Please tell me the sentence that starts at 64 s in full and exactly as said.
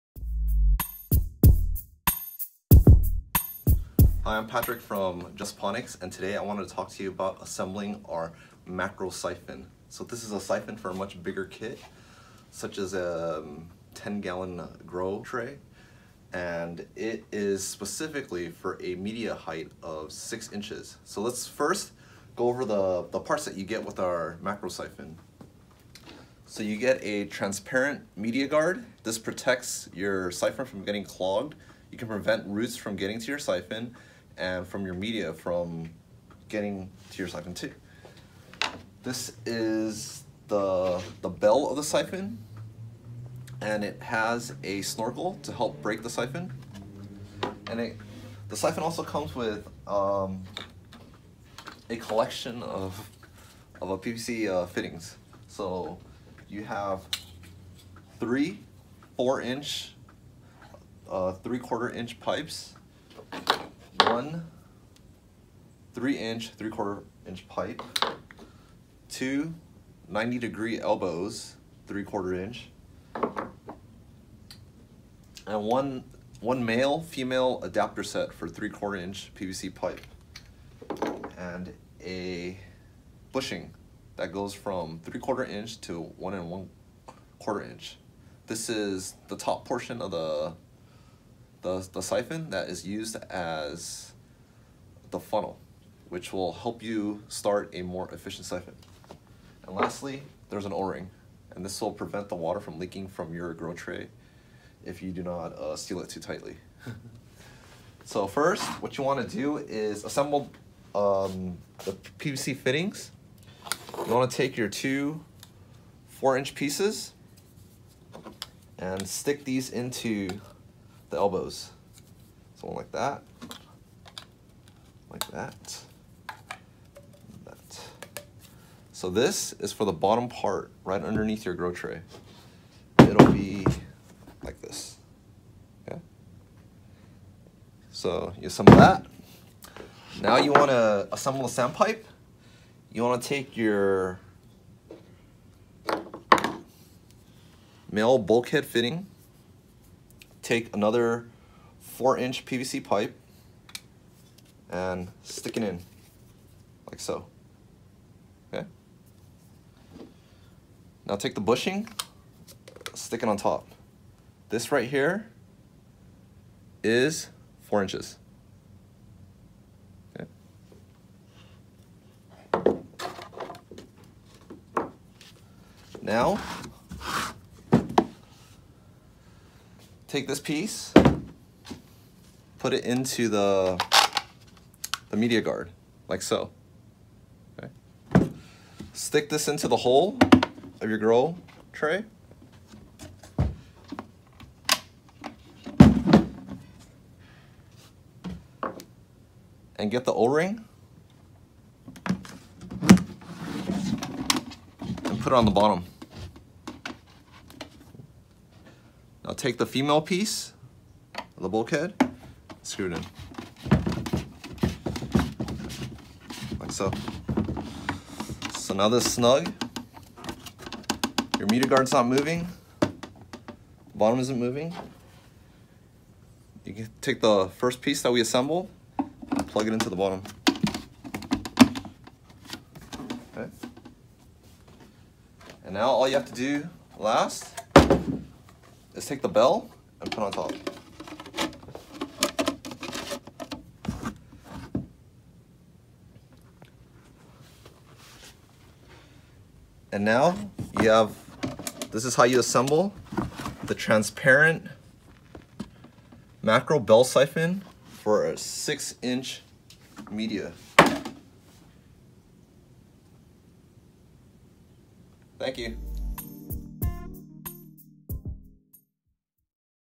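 One three inch, three quarter inch pipe.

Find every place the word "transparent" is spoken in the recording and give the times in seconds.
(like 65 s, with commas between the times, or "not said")
27 s, 253 s.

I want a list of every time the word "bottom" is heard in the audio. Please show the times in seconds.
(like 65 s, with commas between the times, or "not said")
129 s, 205 s, 223 s, 229 s.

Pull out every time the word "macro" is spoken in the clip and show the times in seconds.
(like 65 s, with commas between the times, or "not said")
8 s, 24 s, 256 s.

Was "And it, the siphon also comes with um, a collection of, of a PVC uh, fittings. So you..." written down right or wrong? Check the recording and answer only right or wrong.
right.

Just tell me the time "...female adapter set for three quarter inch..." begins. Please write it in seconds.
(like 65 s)
77 s.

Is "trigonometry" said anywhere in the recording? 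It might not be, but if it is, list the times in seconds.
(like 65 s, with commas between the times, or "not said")
not said.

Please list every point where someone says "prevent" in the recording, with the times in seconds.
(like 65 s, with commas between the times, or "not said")
32 s, 101 s.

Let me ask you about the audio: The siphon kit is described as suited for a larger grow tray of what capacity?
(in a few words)
10-gallon.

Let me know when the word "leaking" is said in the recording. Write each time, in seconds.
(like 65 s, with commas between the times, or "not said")
102 s.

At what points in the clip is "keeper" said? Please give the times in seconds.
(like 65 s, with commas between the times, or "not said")
not said.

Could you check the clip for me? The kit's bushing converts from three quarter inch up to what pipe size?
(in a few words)
1 1/4 inch.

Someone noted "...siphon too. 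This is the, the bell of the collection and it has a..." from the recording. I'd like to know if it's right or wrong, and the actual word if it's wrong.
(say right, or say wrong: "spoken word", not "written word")
wrong: "siphon", not "collection".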